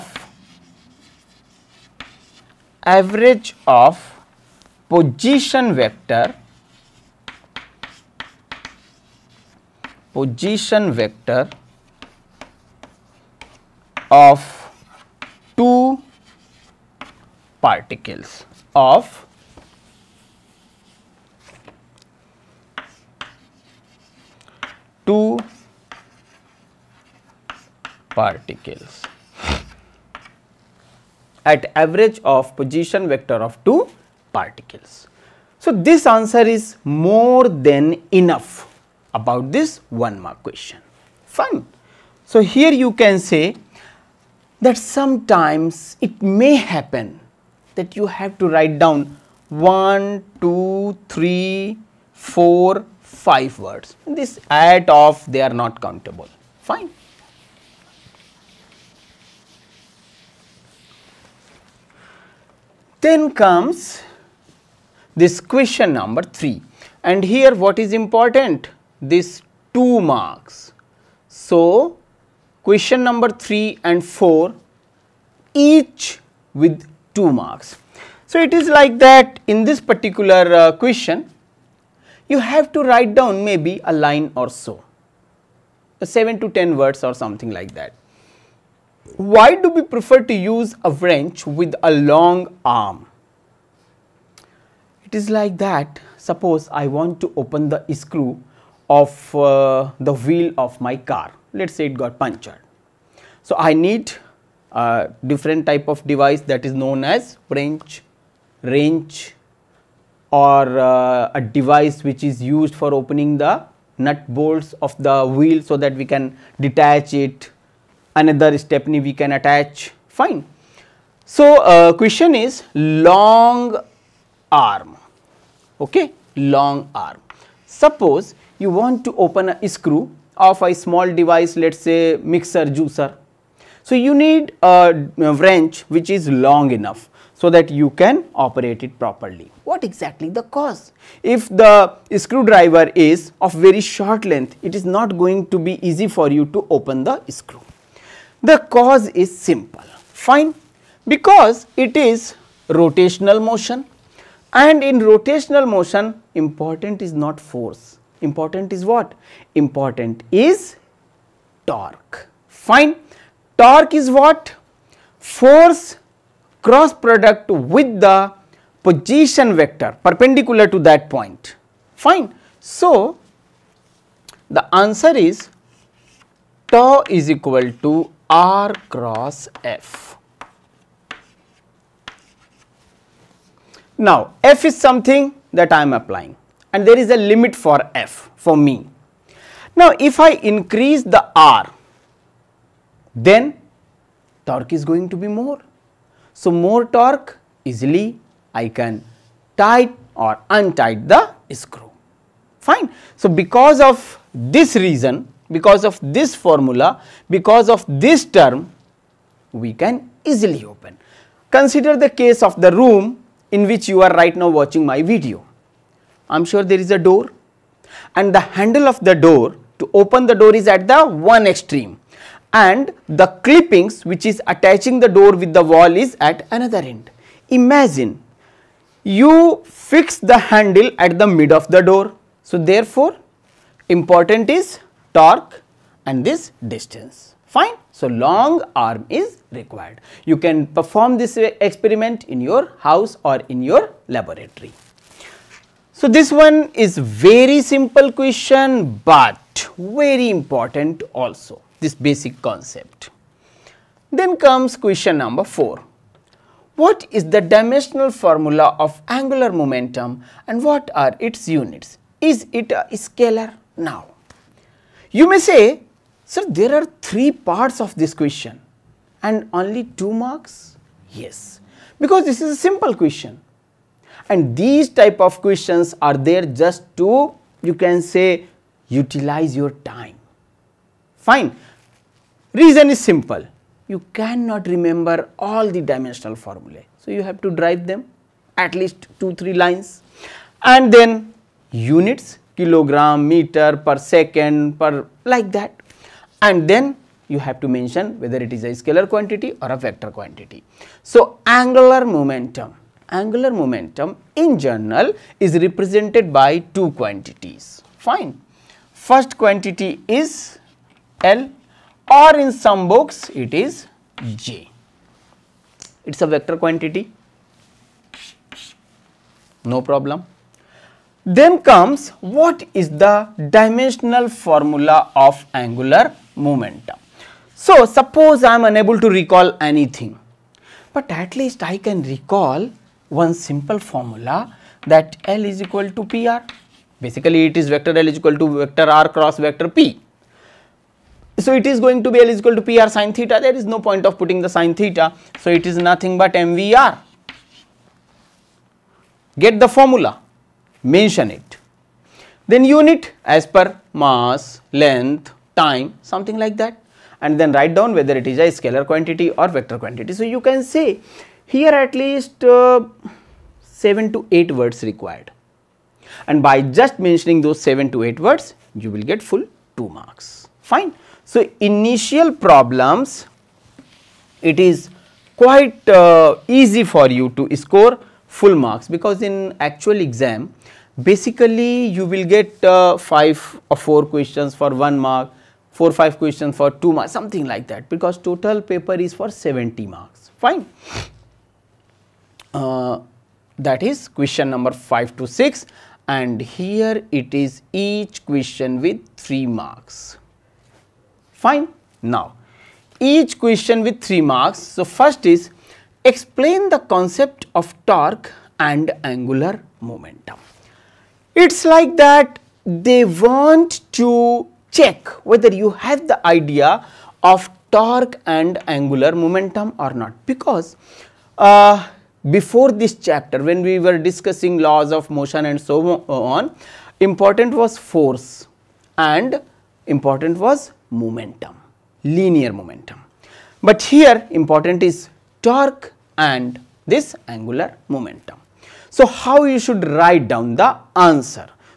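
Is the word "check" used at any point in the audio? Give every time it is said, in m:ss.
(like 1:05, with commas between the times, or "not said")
6:54.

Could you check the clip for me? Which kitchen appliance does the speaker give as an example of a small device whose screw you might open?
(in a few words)
Mixer juicer.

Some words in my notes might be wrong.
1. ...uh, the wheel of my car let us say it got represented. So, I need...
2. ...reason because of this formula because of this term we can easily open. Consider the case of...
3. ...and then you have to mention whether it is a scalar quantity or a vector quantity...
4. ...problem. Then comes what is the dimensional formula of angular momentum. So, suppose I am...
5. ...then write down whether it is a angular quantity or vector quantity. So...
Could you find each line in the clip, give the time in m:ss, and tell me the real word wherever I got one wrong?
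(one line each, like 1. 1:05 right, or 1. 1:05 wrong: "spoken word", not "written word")
1. 1:39 wrong: "punctured", not "represented"
2. 3:24 right
3. 4:56 right
4. 5:19 right
5. 5:57 wrong: "scalar", not "angular".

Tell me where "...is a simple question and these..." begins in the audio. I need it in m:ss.
4:32.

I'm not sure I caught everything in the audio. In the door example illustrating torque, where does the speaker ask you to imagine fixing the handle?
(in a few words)
At the mid of the door.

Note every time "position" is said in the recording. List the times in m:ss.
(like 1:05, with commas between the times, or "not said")
0:04, 0:10, 0:32, 2:48.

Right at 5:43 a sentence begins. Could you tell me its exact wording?
There is no point of putting the sine theta.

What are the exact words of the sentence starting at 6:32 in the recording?
Uh, that is question number 5 to 6 and here it is each question with 3 marks.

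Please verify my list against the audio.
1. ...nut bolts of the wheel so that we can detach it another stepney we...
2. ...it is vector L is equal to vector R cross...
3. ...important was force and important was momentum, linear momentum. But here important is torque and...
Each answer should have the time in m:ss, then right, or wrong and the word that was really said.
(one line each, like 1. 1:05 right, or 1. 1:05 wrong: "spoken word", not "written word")
1. 1:53 right
2. 5:37 right
3. 7:06 right.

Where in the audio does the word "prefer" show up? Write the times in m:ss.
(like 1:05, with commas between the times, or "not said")
1:29.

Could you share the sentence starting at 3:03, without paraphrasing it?
Now, f is something that I am applying and there is a limit for f for me.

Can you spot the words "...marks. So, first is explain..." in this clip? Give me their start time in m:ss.
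6:44.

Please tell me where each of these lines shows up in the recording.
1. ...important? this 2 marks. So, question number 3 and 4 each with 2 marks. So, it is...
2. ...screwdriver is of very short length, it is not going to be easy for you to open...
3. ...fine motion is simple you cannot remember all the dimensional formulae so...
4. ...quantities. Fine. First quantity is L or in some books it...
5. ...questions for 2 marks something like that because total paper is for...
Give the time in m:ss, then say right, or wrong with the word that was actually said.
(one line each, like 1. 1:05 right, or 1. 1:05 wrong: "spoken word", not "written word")
1. 1:08 right
2. 2:22 right
3. 4:41 wrong: "reason", not "motion"
4. 5:06 right
5. 6:26 right.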